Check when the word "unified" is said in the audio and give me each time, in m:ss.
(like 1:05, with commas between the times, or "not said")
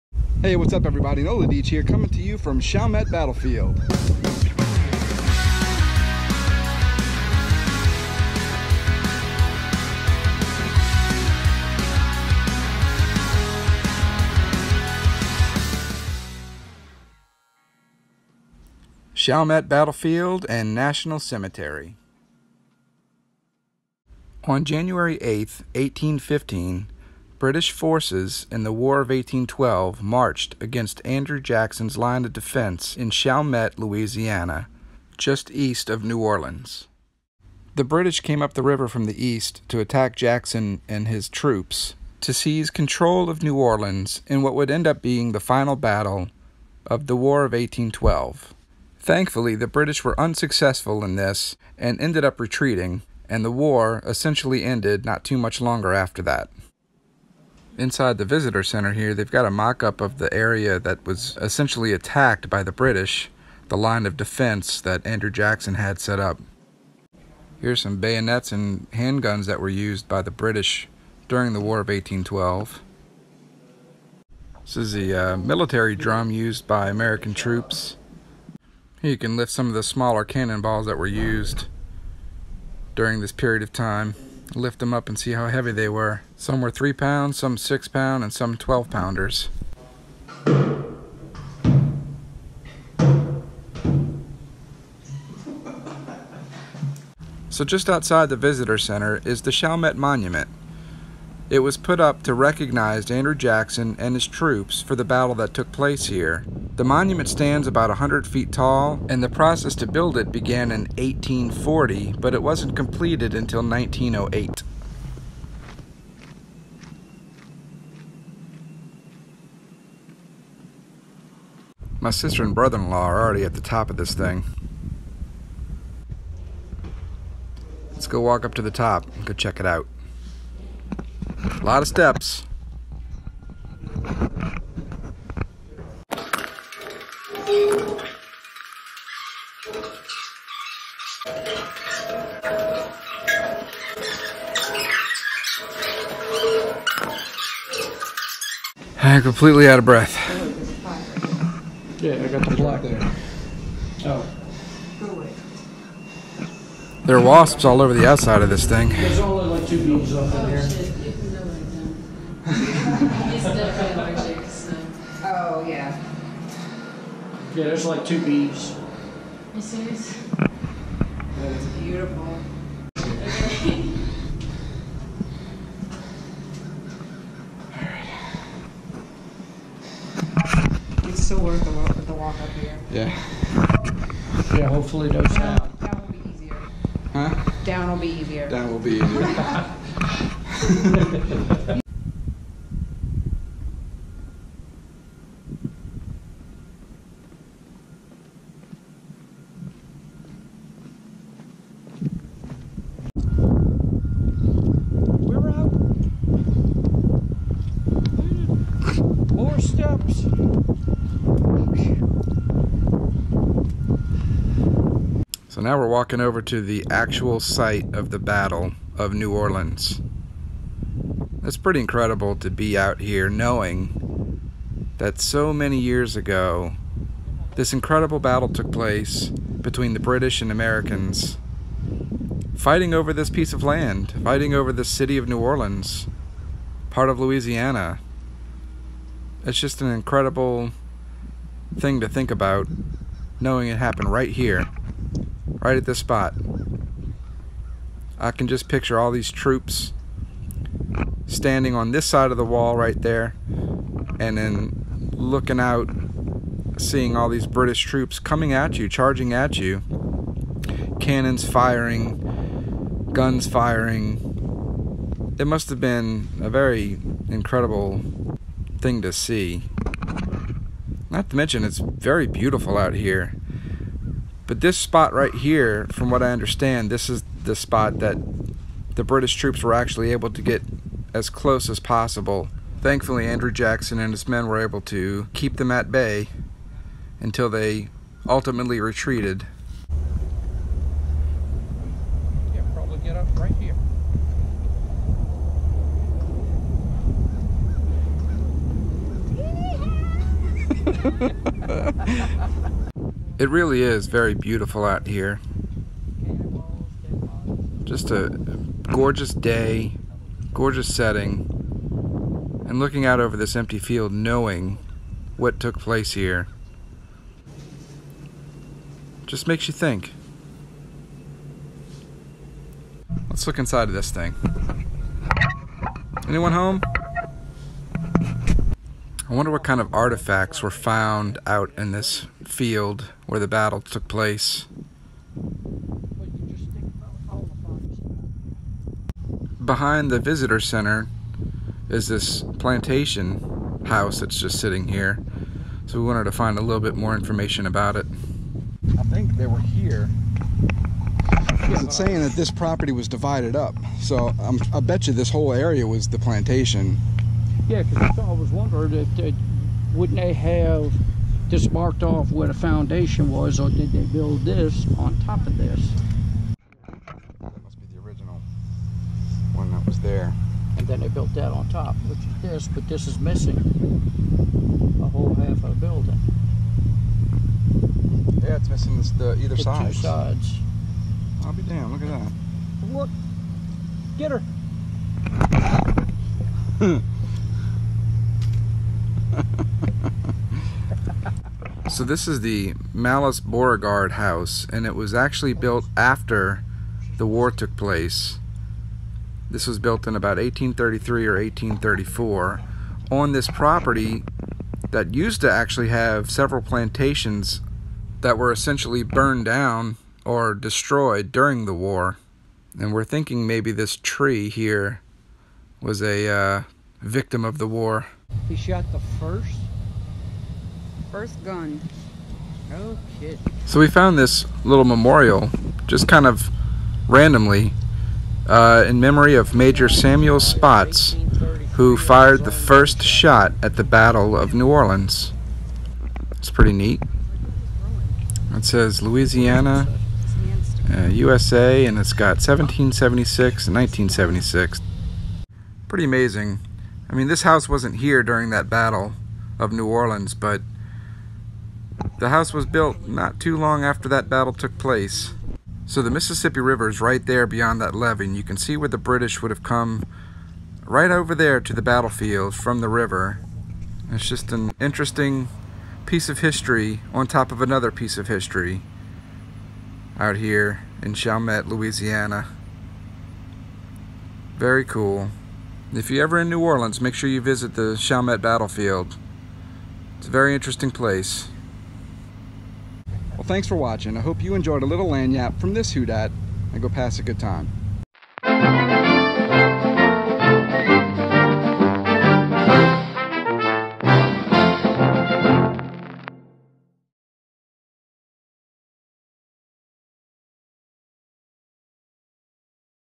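not said.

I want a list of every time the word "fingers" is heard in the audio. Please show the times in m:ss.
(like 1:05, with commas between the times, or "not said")
not said.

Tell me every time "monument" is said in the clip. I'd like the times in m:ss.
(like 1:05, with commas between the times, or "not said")
1:39, 1:46.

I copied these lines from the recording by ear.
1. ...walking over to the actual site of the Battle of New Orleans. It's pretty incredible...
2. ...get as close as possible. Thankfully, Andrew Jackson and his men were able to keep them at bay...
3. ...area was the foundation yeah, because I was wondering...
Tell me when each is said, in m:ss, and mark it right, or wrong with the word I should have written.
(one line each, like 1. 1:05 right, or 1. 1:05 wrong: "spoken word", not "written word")
1. 3:35 right
2. 4:40 right
3. 5:55 wrong: "plantation", not "foundation".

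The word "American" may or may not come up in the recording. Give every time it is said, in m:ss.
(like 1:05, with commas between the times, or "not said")
1:16, 3:50.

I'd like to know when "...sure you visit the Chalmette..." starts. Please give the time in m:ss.
7:57.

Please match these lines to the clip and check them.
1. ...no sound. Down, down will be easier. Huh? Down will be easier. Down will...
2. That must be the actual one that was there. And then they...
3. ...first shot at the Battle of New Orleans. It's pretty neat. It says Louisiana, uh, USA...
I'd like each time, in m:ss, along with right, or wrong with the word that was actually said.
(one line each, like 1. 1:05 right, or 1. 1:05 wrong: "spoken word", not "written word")
1. 3:05 right
2. 6:06 wrong: "original", not "actual"
3. 7:12 right.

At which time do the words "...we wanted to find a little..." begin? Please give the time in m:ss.
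5:46.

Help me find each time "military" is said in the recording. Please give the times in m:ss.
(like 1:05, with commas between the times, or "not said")
1:15.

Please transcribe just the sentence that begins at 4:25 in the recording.
It must have been a very incredible thing to see.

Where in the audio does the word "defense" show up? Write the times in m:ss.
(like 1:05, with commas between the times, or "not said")
0:32, 1:04.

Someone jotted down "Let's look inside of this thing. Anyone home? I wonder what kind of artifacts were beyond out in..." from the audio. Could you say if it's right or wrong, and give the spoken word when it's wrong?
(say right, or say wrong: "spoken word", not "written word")
wrong: "found", not "beyond".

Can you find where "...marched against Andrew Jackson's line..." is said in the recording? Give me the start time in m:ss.
0:30.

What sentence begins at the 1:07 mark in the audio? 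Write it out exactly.
Here's some bayonets and handguns that were used by the British during the War of 1812.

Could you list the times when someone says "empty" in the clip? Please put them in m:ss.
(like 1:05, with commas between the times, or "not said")
5:13.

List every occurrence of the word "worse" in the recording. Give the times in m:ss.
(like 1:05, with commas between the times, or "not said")
not said.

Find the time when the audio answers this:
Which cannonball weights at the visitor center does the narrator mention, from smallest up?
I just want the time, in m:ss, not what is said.
1:26.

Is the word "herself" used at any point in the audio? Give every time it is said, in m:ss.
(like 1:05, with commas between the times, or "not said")
not said.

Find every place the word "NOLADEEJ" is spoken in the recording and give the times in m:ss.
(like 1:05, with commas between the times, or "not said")
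0:01.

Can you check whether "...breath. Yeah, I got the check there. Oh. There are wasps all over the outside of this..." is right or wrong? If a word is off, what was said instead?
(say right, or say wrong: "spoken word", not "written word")
wrong: "block", not "check".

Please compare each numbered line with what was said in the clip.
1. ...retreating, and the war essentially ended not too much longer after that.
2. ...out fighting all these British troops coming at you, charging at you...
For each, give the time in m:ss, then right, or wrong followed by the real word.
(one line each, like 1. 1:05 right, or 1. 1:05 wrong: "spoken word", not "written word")
1. 0:52 right
2. 4:15 wrong: "seeing", not "fighting".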